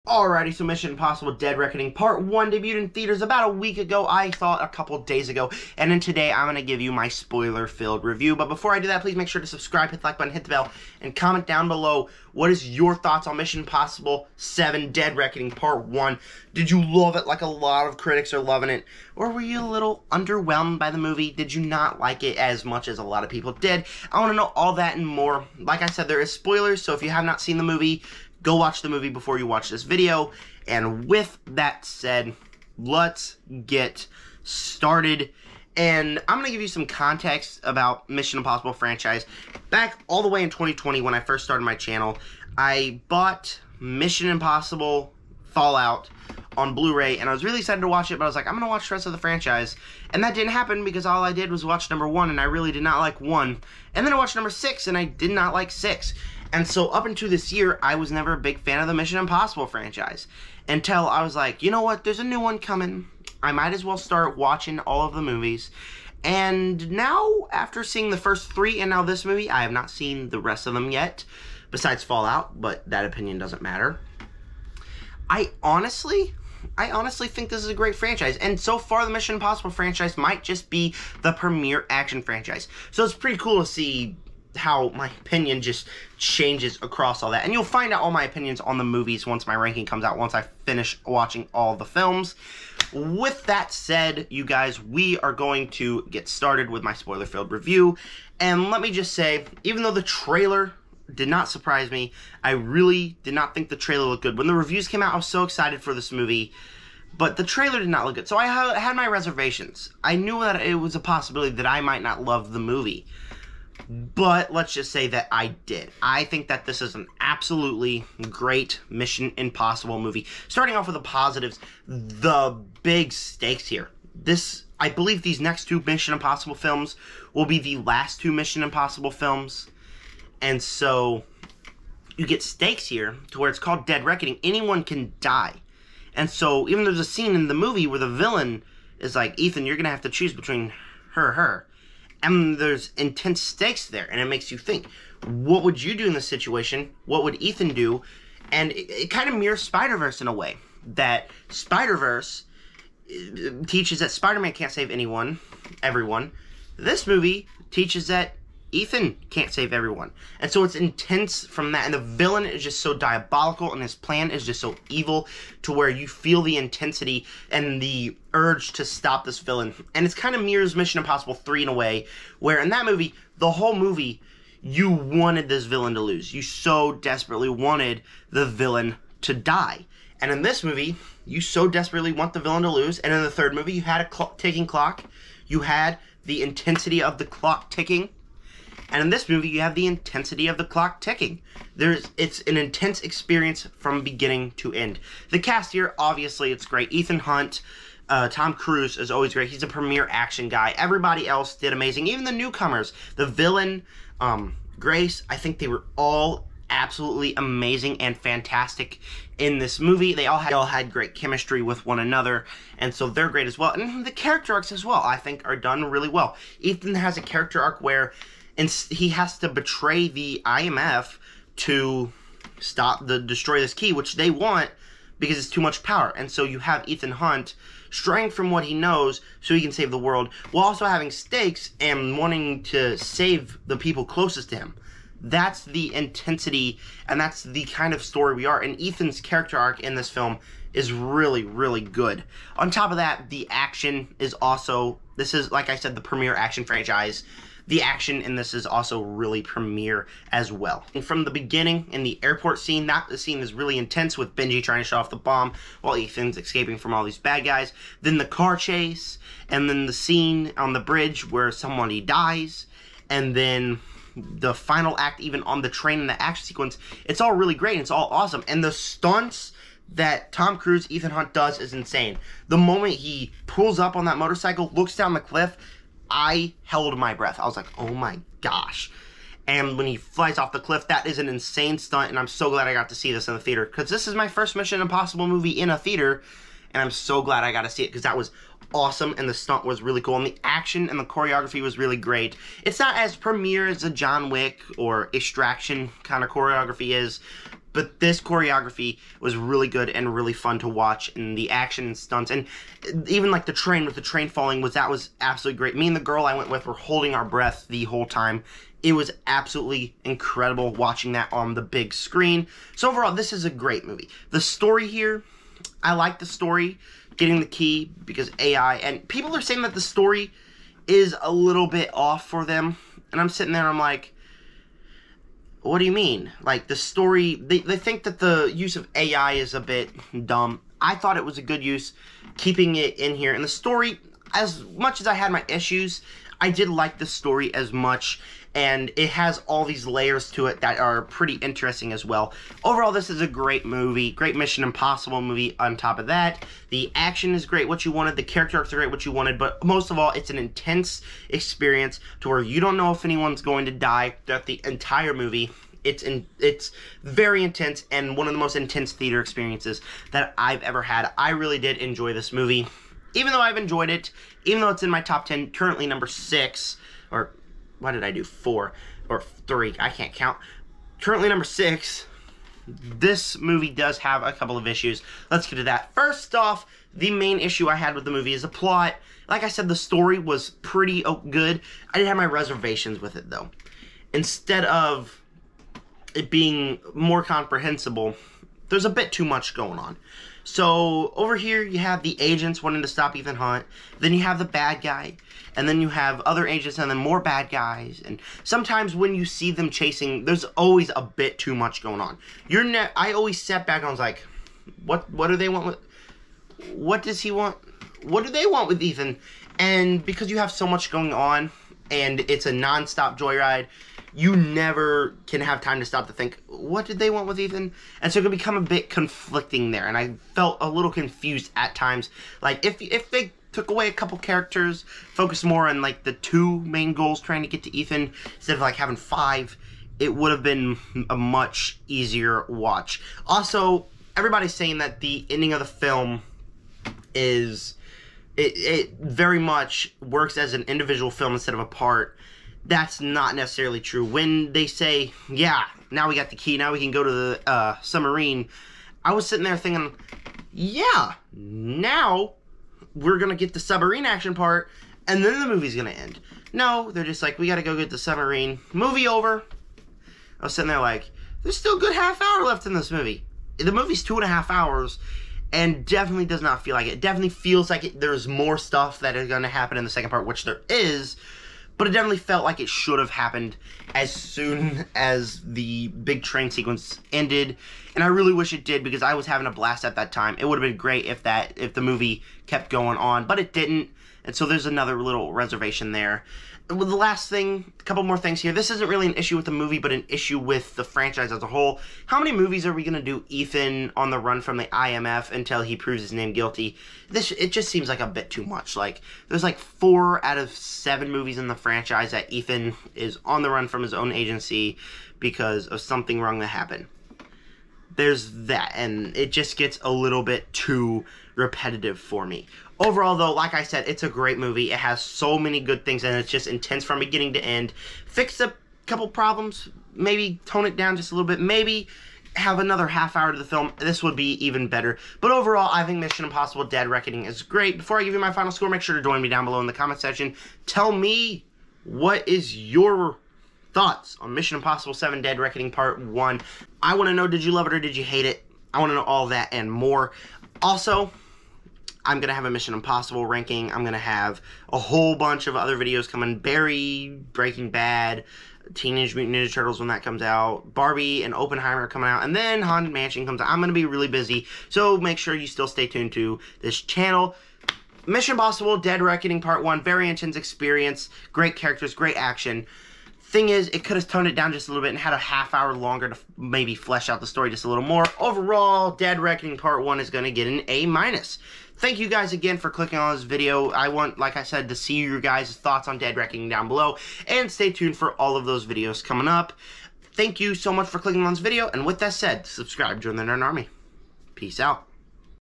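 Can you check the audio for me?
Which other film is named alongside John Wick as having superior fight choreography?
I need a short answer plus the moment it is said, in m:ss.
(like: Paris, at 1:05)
Extraction, at 4:55.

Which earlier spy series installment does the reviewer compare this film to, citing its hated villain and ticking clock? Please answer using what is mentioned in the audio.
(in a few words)
Mission Impossible 3.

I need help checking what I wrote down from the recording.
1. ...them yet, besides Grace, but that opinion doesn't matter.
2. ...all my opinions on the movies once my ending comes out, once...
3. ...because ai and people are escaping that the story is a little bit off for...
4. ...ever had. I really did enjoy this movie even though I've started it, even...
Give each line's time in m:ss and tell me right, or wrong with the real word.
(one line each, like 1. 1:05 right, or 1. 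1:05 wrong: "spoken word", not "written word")
1. 1:10 wrong: "Fallout", not "Grace"
2. 1:28 wrong: "ranking", not "ending"
3. 5:18 wrong: "saying", not "escaping"
4. 6:00 wrong: "enjoyed", not "started".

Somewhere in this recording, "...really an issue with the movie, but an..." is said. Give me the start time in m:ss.
8:08.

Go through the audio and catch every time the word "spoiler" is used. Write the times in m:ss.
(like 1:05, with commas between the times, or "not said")
0:07, 0:26, 1:36.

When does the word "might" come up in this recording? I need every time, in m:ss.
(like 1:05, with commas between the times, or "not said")
1:03, 1:20, 1:51.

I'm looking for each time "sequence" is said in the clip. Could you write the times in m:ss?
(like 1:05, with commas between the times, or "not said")
4:26, 7:56.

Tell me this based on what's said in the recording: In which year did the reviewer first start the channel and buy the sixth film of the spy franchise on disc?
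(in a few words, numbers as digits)
2020.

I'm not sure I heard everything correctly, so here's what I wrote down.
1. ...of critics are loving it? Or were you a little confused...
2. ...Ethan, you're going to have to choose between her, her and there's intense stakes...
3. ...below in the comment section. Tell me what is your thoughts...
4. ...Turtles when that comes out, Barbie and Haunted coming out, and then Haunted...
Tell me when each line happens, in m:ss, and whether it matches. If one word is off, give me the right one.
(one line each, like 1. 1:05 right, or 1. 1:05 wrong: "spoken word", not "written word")
1. 0:17 wrong: "underwhelmed", not "confused"
2. 2:19 right
3. 8:49 right
4. 9:09 wrong: "Oppenheimer", not "Haunted".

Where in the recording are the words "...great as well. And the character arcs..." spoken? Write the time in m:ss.
3:33.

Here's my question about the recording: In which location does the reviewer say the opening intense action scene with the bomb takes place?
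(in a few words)
The airport.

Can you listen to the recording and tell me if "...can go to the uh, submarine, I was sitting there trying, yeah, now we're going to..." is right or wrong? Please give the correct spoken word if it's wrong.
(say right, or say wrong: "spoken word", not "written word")
wrong: "thinking", not "trying".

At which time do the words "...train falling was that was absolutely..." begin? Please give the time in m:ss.
5:04.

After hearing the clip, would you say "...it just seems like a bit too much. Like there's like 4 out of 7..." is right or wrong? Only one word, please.
right.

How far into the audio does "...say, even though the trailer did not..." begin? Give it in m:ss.
1:39.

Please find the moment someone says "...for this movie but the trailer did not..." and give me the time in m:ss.
1:45.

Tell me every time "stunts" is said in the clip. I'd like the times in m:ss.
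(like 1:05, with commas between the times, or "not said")
4:28, 4:41, 4:49, 5:01.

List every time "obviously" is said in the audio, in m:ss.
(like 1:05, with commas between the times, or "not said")
3:15.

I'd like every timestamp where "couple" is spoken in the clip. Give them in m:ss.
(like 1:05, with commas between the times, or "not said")
0:04, 6:14, 7:03, 8:07, 8:38.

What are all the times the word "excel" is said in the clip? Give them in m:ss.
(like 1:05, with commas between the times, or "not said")
not said.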